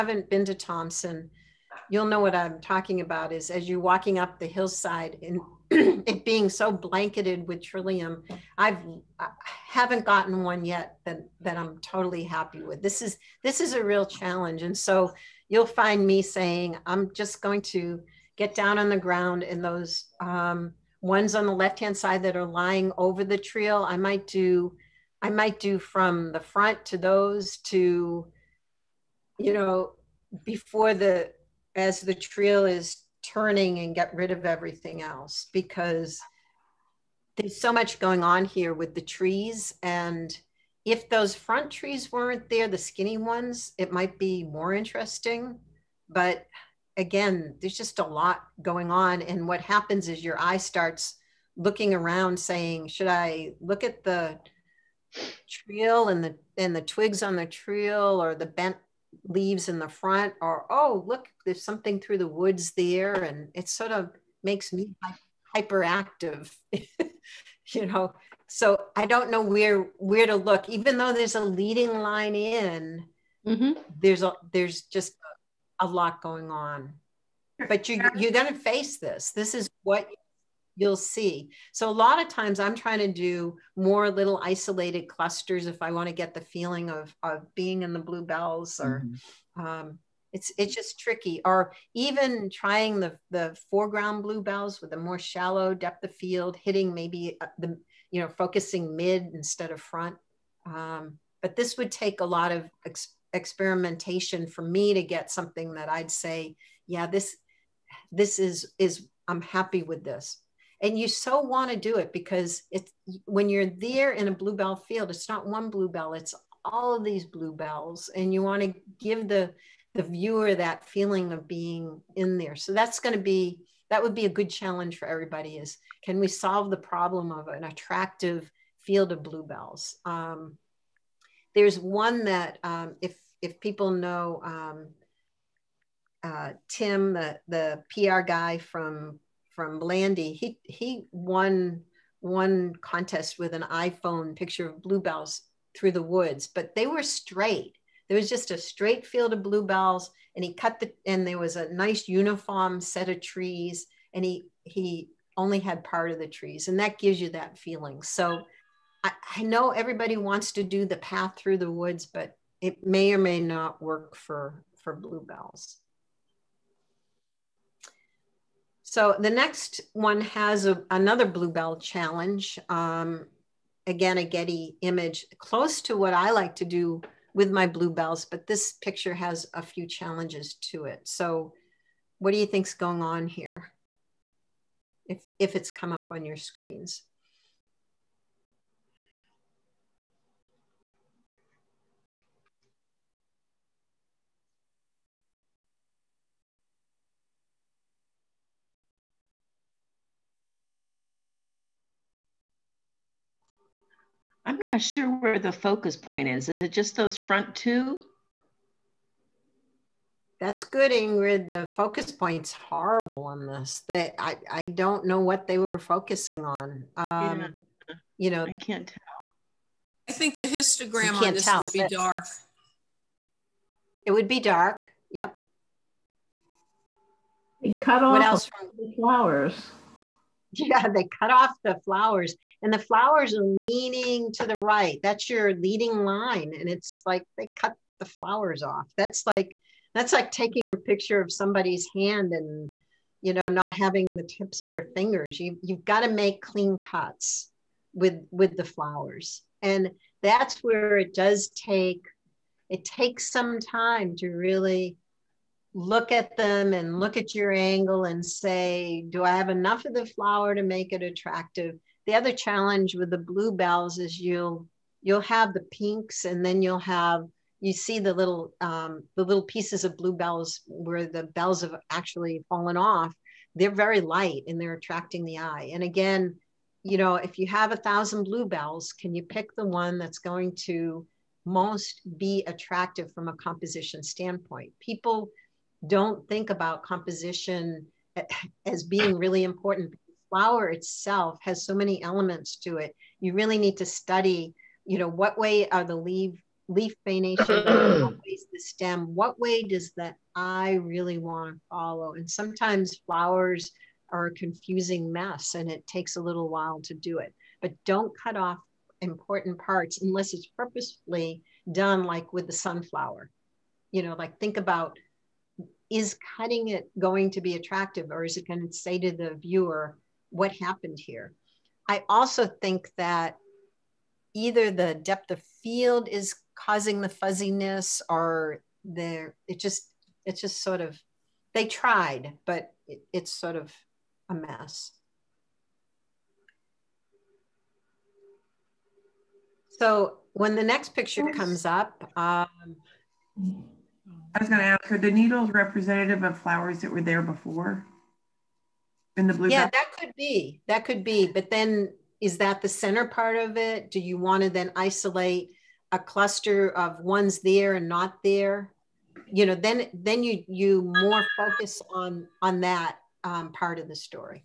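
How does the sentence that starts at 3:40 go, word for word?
I think the histogram on this tell.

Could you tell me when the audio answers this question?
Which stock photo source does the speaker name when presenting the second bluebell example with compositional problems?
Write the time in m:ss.
2:54.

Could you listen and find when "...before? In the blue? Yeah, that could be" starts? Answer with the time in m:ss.
5:47.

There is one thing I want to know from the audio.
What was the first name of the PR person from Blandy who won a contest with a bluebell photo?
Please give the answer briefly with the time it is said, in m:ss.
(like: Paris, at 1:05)
Tim, at 2:16.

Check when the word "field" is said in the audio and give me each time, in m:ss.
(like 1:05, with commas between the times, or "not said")
1:36, 1:54, 2:08, 2:29, 5:25.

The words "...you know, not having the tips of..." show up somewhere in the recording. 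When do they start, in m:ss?
4:03.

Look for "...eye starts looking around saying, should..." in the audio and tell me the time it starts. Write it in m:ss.
0:50.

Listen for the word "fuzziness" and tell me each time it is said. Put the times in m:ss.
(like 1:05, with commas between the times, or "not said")
5:27.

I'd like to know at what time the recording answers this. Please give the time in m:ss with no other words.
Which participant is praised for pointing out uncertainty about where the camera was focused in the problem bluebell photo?
3:30.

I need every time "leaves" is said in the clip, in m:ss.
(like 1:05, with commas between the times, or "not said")
0:59.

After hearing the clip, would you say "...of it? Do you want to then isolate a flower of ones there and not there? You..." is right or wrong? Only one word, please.
wrong.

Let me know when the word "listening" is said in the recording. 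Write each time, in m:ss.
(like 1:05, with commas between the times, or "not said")
not said.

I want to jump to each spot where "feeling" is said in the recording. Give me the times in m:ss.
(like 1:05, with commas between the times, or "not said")
1:26, 2:00, 2:37.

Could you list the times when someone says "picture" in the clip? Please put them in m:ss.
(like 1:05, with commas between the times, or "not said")
2:24, 2:58, 4:00, 5:40.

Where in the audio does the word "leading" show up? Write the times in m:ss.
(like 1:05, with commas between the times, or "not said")
1:11, 3:55.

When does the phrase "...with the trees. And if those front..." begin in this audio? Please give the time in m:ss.
0:38.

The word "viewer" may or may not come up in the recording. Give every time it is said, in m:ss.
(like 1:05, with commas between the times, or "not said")
2:00, 5:19.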